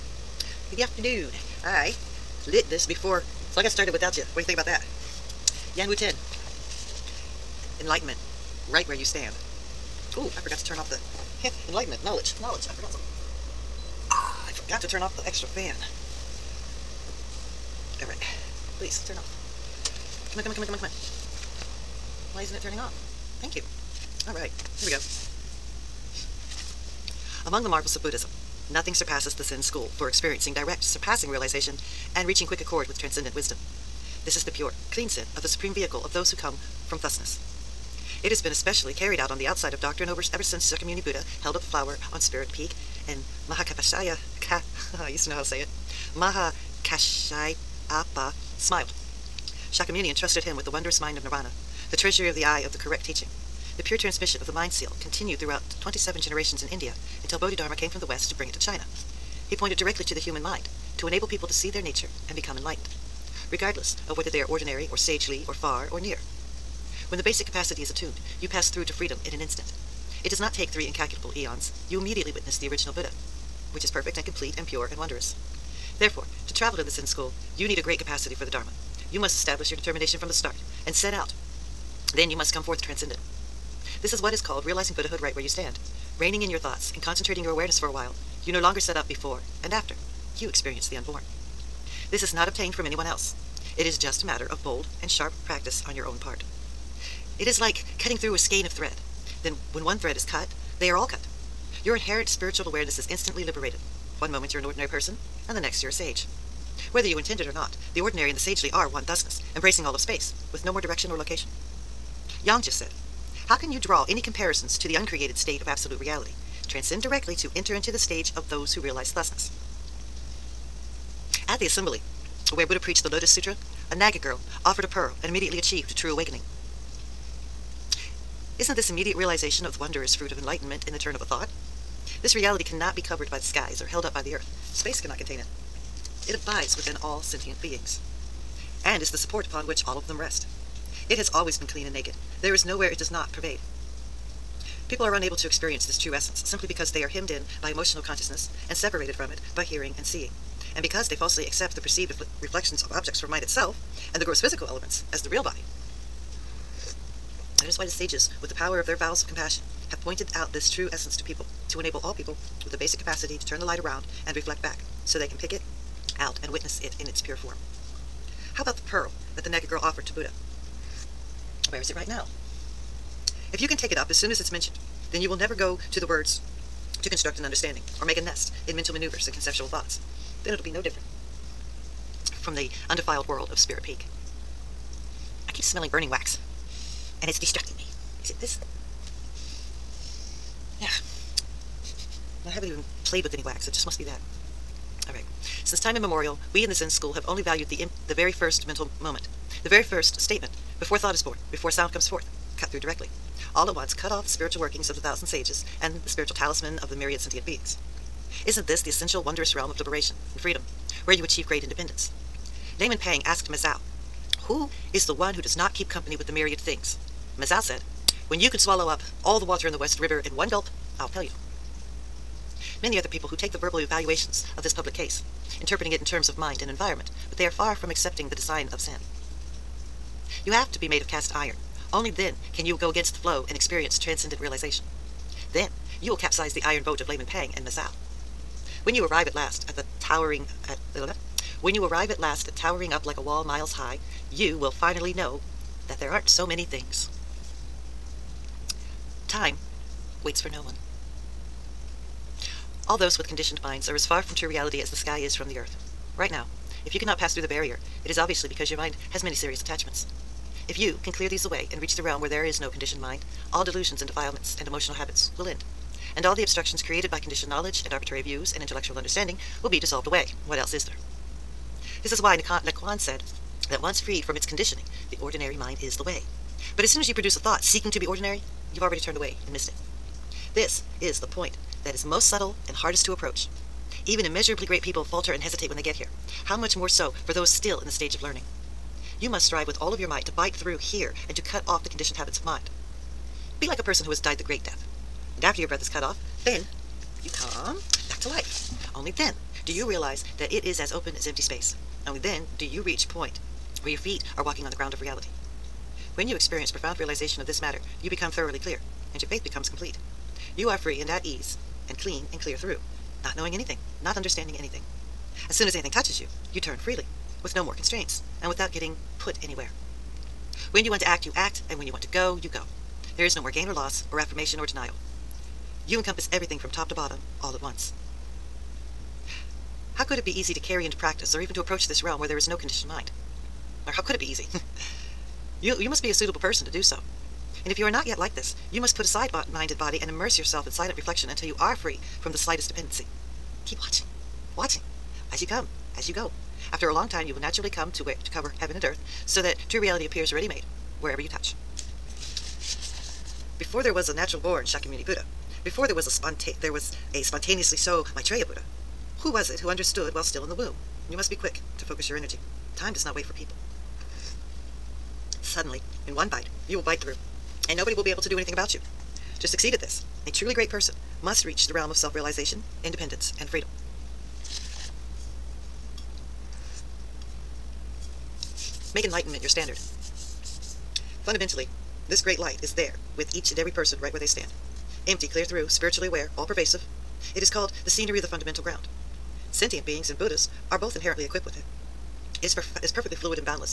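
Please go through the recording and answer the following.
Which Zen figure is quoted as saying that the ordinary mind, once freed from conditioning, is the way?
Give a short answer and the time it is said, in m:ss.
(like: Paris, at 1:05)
Nanquan, at 4:32.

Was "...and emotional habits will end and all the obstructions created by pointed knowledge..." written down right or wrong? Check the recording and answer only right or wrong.
wrong.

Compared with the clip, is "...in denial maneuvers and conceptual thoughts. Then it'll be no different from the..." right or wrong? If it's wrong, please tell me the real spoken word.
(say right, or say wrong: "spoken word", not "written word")
wrong: "mental", not "denial".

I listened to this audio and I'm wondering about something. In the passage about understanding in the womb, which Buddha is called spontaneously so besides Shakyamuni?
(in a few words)
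Maitreya.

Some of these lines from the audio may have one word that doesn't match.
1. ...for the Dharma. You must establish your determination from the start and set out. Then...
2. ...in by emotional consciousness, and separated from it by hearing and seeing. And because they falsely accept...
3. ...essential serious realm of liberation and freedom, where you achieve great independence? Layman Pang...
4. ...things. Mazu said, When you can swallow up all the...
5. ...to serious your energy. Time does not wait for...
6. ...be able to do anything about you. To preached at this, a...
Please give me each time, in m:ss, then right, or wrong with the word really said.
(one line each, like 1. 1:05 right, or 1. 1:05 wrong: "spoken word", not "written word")
1. 1:18 right
2. 2:27 right
3. 3:28 wrong: "wondrous", not "serious"
4. 3:36 right
5. 6:01 wrong: "focus", not "serious"
6. 6:08 wrong: "succeed", not "preached".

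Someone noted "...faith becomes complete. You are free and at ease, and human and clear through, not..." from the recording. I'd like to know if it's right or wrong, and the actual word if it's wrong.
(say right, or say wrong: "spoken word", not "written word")
wrong: "clean", not "human".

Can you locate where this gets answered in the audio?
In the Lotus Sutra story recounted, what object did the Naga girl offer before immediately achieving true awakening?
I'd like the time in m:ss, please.
2:04.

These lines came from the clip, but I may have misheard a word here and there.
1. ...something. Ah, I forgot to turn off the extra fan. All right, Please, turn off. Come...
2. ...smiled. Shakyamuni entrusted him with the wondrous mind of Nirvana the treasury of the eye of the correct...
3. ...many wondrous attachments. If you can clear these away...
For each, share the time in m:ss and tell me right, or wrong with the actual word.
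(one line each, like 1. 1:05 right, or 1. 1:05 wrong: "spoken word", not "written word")
1. 0:12 right
2. 0:48 right
3. 4:19 wrong: "serious", not "wondrous".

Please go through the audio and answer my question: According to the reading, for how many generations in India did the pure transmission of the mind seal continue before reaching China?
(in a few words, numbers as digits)
27.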